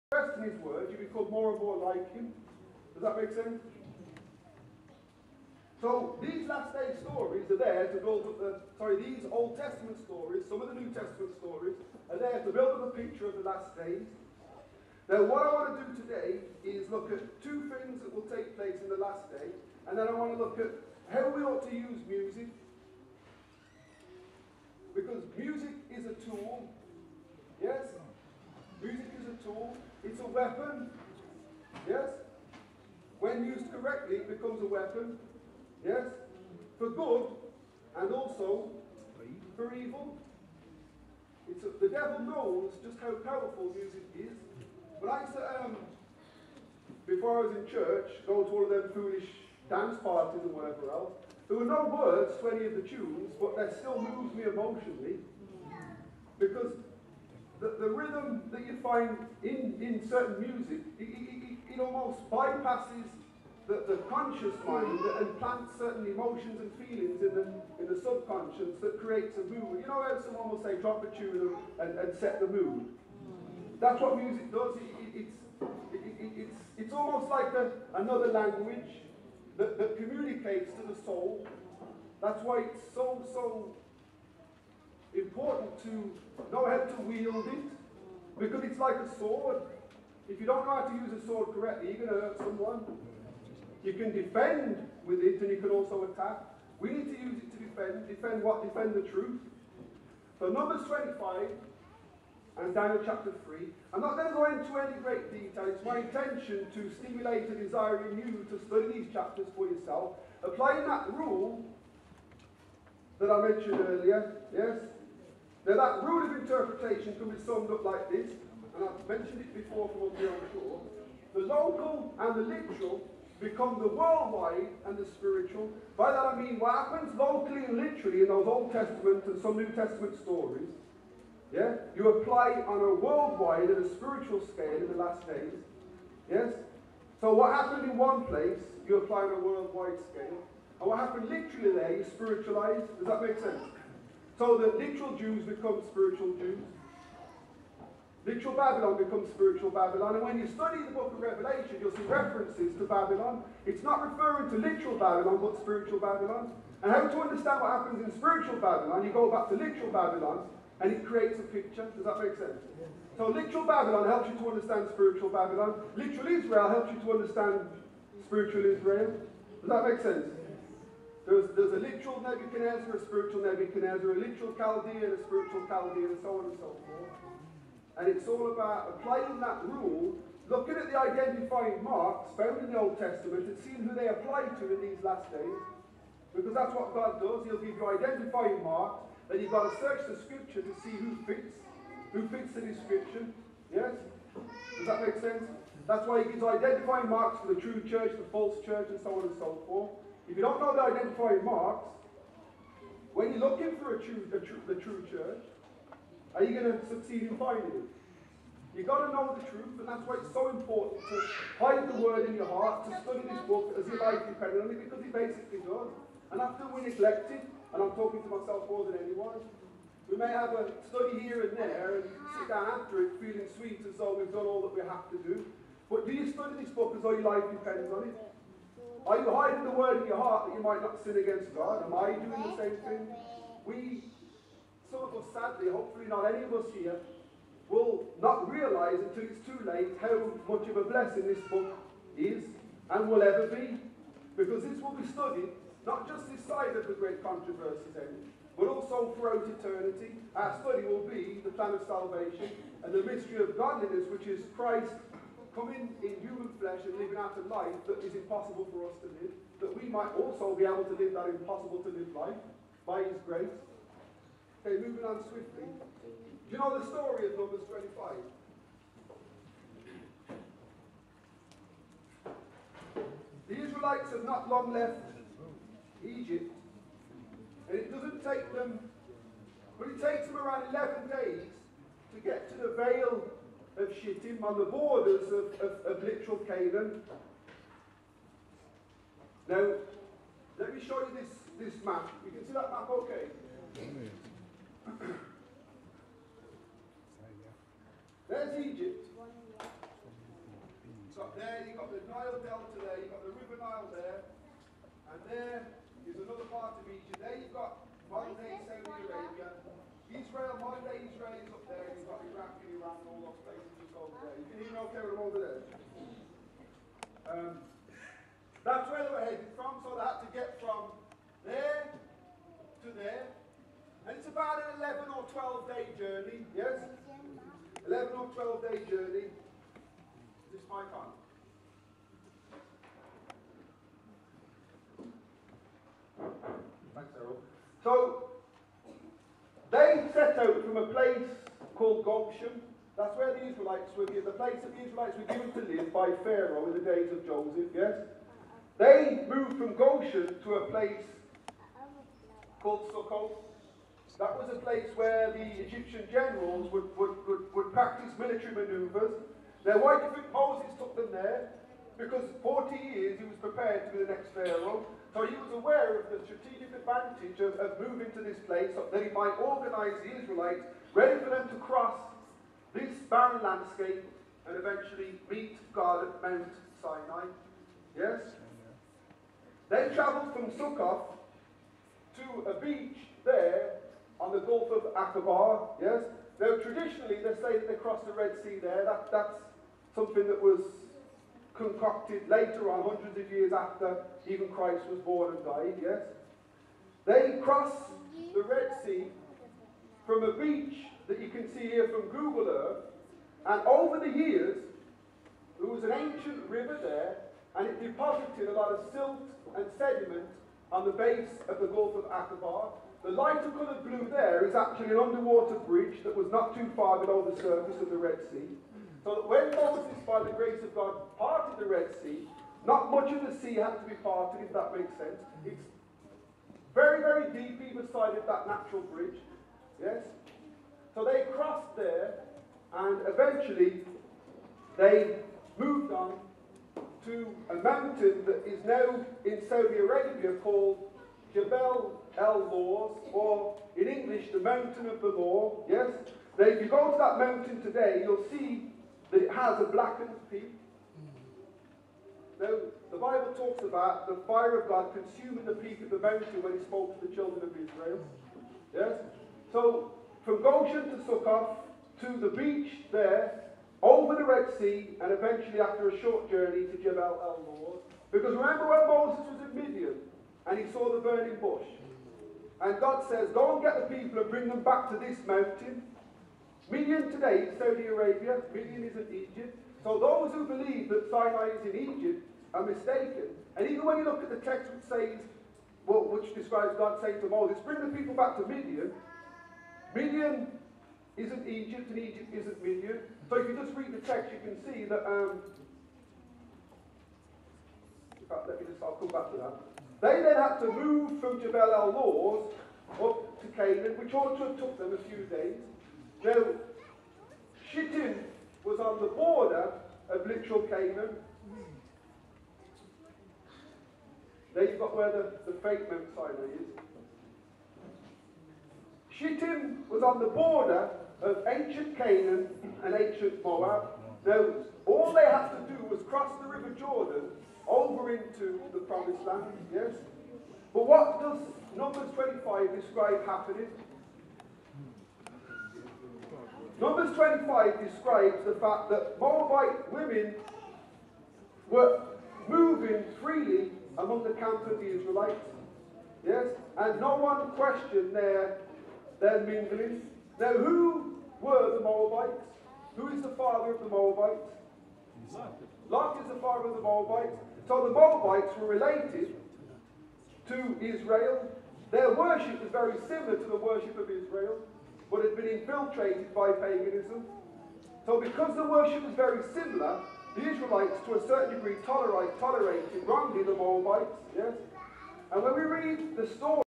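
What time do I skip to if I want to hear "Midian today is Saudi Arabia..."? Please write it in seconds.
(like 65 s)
476 s.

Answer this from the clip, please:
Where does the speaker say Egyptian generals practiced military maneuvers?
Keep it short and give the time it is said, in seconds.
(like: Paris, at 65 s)
Sukkot, at 352 s.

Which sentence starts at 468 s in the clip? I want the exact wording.
Because remember when Moses was in Midian and he saw the burning bush?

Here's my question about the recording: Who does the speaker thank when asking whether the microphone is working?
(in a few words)
Errol.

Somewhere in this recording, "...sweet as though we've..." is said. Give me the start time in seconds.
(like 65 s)
223 s.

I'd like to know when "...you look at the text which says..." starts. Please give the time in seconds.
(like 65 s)
483 s.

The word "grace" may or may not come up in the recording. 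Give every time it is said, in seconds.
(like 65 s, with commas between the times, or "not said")
263 s, 420 s.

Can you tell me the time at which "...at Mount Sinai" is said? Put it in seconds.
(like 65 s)
376 s.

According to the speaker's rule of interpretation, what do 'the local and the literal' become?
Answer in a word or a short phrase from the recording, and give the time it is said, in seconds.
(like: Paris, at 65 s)
the worldwide and the spiritual, at 123 s.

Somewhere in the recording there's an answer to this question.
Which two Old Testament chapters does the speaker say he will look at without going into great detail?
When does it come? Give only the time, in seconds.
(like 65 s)
100 s.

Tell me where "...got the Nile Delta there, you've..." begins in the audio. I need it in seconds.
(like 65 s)
301 s.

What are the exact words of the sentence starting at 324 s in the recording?
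And it's about an 11 or 12 day journey, yes?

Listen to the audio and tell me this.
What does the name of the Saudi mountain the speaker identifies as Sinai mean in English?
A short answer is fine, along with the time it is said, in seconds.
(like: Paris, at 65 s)
the Mountain of the Law, at 444 s.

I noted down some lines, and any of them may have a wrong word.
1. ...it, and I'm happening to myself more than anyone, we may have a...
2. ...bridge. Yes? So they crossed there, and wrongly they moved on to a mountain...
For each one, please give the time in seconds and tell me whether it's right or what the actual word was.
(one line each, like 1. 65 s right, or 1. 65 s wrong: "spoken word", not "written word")
1. 217 s wrong: "talking", not "happening"
2. 428 s wrong: "eventually", not "wrongly".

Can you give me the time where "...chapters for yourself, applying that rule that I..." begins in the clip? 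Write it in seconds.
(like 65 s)
109 s.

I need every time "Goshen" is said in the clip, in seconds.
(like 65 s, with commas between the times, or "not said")
342 s, 349 s, 460 s.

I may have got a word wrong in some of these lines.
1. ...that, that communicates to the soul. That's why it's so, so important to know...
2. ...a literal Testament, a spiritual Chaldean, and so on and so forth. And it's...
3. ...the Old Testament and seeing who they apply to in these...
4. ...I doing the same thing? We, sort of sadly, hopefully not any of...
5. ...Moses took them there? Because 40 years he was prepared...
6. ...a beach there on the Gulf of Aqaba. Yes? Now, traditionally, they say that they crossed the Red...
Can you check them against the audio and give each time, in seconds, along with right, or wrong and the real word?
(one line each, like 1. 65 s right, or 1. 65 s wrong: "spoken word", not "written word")
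1. 79 s right
2. 174 s wrong: "Chaldean", not "Testament"
3. 182 s right
4. 231 s right
5. 360 s right
6. 382 s right.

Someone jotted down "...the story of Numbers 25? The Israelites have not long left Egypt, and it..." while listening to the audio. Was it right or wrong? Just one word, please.
right.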